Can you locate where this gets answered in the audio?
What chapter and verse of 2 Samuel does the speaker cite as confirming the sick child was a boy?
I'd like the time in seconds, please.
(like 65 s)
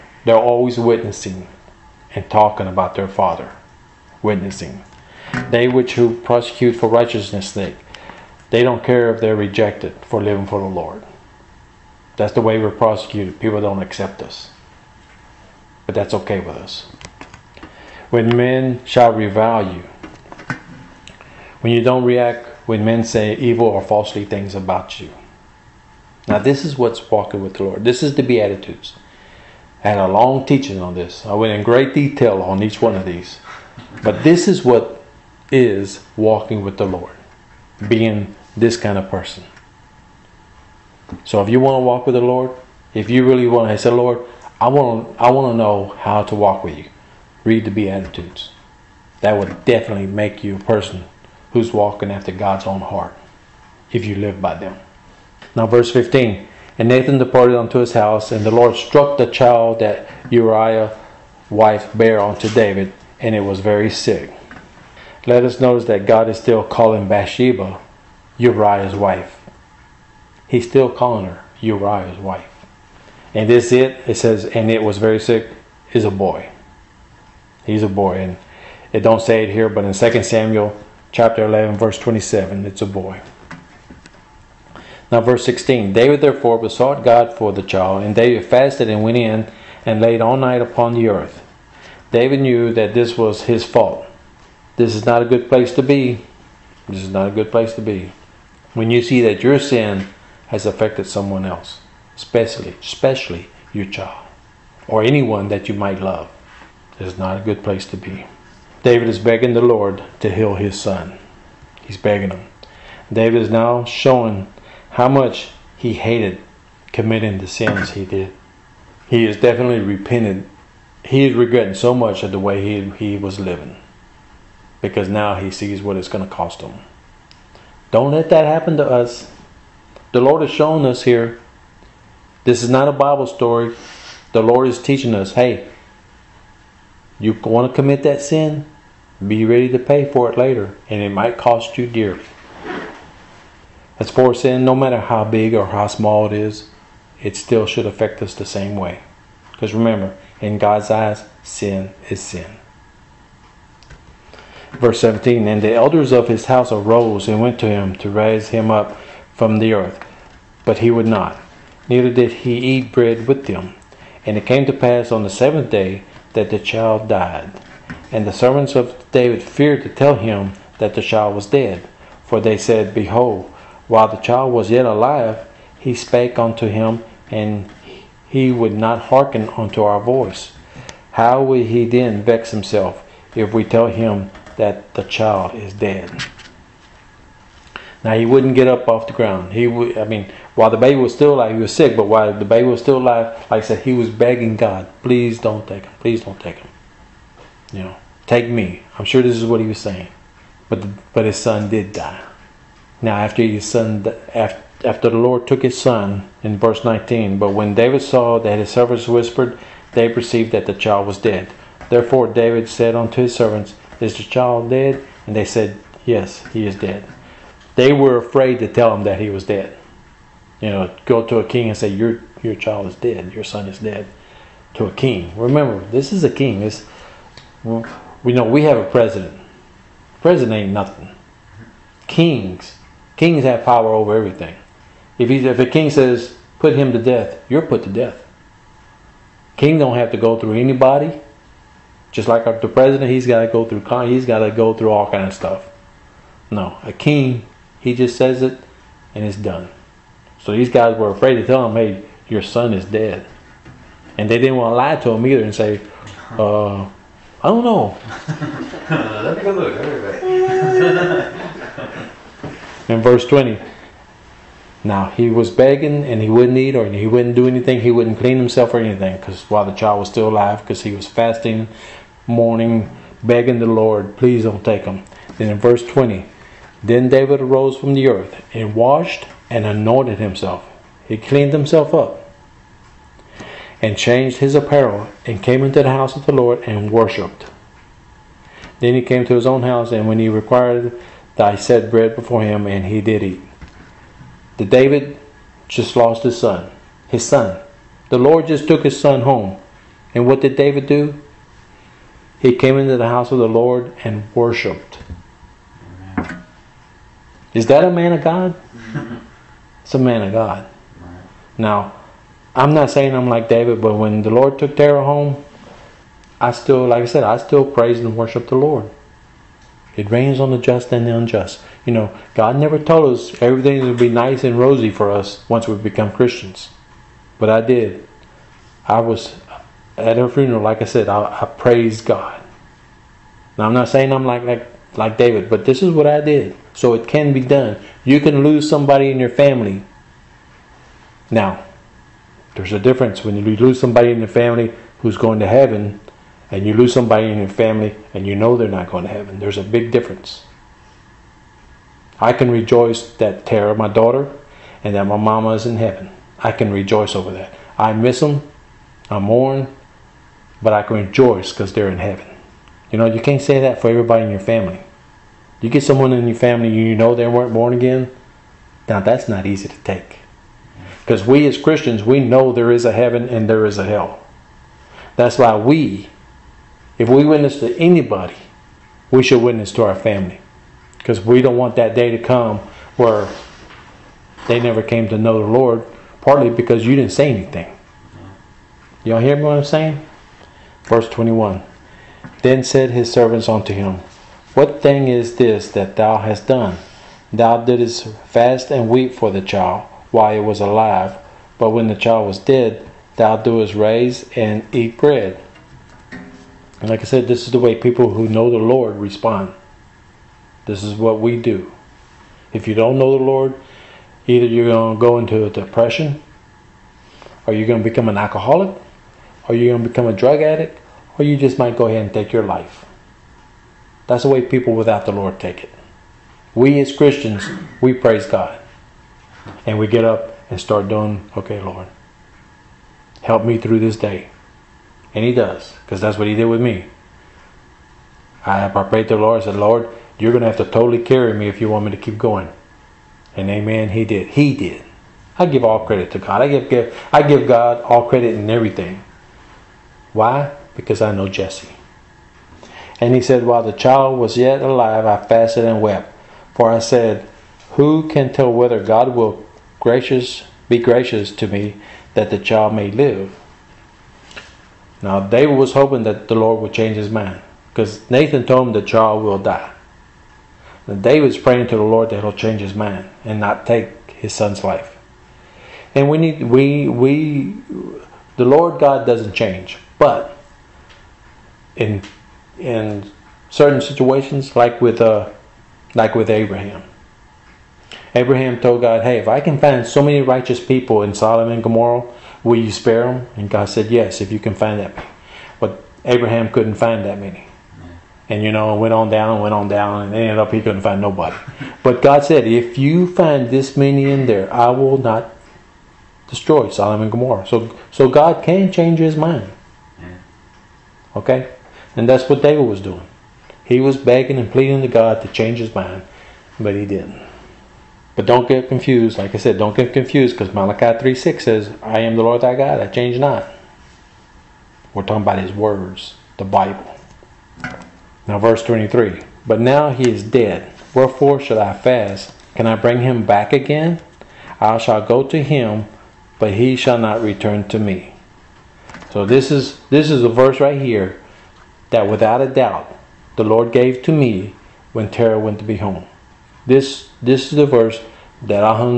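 81 s.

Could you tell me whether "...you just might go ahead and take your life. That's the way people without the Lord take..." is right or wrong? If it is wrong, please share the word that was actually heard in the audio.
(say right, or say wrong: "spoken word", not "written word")
right.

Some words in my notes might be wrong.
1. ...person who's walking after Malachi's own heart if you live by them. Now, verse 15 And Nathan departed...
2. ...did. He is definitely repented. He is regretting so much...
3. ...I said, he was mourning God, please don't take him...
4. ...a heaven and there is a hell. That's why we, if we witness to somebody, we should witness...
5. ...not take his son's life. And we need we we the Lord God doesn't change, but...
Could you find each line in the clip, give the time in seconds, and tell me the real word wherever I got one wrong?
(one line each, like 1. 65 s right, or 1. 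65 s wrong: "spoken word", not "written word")
1. 50 s wrong: "God", not "Malachi"
2. 118 s right
3. 193 s wrong: "begging", not "mourning"
4. 372 s wrong: "anybody", not "somebody"
5. 473 s right.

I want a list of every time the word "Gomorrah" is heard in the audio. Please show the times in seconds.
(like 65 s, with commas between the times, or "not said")
491 s, 507 s.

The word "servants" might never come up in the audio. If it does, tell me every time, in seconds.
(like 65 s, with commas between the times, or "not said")
168 s, 208 s, 213 s, 393 s.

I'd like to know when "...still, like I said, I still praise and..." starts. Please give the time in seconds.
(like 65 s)
316 s.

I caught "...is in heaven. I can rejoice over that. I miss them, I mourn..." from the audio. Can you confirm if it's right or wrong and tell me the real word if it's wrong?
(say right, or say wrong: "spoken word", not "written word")
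right.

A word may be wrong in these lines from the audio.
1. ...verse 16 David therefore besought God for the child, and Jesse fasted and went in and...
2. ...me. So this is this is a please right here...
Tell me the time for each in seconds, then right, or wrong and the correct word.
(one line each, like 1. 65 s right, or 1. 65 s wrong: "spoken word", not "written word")
1. 85 s wrong: "David", not "Jesse"
2. 537 s wrong: "verse", not "please".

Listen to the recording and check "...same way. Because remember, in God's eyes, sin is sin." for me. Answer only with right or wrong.
right.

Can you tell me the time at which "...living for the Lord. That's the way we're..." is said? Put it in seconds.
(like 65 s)
10 s.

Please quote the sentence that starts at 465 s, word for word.
Now David was hoping that the Lord would change his mind.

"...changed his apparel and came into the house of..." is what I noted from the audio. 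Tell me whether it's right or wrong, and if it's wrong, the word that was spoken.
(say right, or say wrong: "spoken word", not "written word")
right.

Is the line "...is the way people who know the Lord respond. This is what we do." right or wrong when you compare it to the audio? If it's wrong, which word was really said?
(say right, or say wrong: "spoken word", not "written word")
right.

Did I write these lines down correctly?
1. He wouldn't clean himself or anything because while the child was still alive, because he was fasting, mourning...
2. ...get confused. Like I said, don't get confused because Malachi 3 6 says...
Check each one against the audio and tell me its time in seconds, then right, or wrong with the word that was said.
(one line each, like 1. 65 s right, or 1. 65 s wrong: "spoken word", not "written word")
1. 267 s right
2. 518 s right.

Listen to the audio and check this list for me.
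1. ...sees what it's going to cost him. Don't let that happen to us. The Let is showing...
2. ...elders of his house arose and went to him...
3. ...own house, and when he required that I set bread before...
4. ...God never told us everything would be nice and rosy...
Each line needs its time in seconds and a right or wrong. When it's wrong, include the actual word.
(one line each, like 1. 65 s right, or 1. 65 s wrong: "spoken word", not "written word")
1. 125 s wrong: "Lord", not "Let"
2. 155 s right
3. 289 s right
4. 322 s right.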